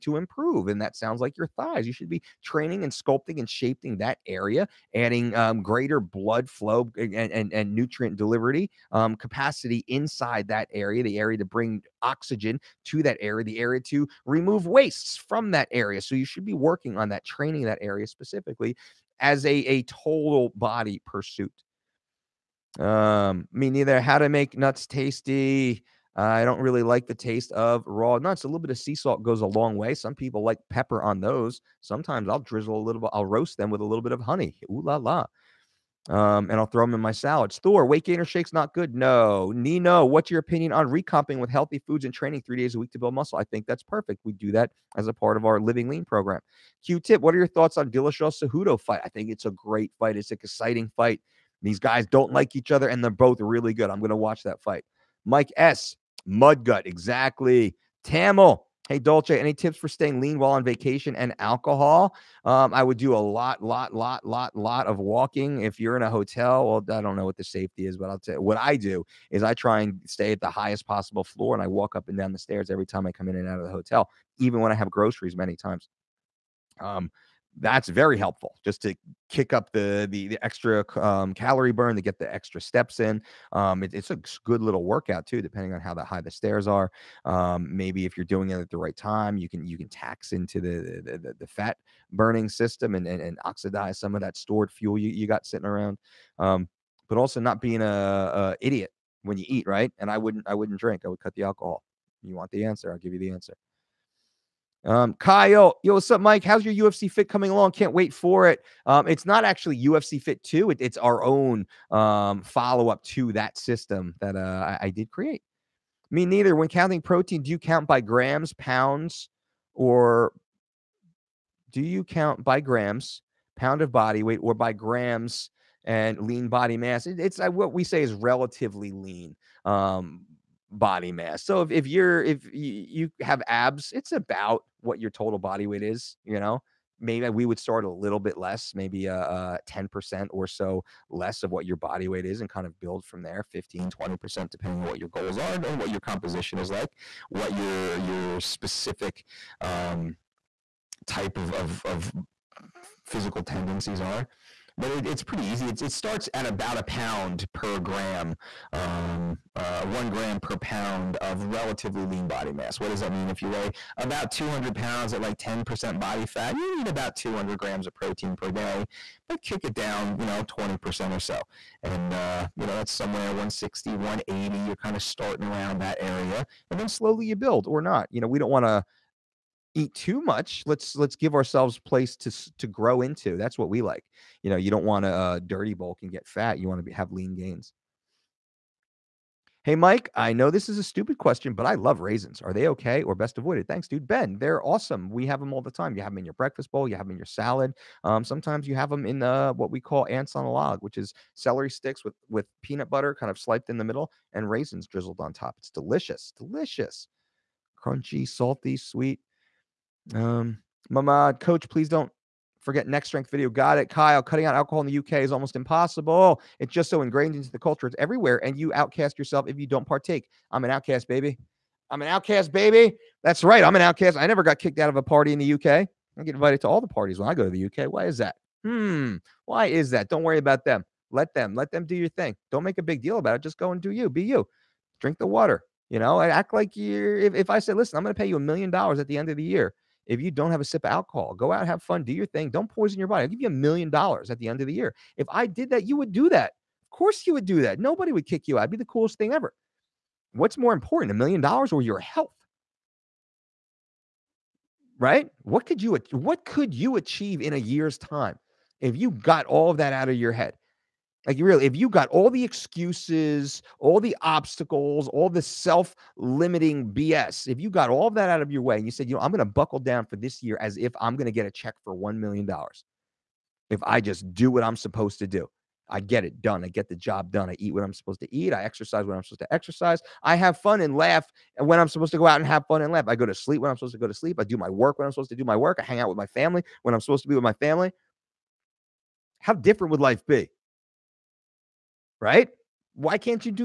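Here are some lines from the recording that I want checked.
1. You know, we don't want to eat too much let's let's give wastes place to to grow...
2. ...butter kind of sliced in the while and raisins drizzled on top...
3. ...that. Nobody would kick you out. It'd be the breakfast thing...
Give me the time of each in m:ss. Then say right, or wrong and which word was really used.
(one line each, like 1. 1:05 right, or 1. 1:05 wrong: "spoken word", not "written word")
1. 2:58 wrong: "ourselves", not "wastes"
2. 3:22 wrong: "middle", not "while"
3. 4:07 wrong: "coolest", not "breakfast".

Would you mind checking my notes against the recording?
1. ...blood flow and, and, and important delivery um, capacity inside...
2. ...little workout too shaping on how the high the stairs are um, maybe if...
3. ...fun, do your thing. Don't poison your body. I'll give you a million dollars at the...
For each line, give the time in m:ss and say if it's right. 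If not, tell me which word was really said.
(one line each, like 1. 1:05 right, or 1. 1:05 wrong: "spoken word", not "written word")
1. 0:05 wrong: "nutrient", not "important"
2. 1:24 wrong: "depending", not "shaping"
3. 4:01 right.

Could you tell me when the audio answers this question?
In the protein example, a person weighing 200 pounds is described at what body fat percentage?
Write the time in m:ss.
2:45.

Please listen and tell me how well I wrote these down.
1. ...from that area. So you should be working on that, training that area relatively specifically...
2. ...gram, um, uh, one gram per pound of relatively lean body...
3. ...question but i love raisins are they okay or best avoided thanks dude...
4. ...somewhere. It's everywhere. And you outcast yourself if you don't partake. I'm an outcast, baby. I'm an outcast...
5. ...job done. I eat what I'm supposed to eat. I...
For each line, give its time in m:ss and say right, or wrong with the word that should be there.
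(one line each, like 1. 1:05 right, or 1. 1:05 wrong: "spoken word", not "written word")
1. 0:15 wrong: "specifically", not "relatively"
2. 2:37 right
3. 3:11 right
4. 3:37 wrong: "culture", not "somewhere"
5. 4:36 right.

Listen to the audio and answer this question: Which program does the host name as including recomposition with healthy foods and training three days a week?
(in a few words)
Living Lean.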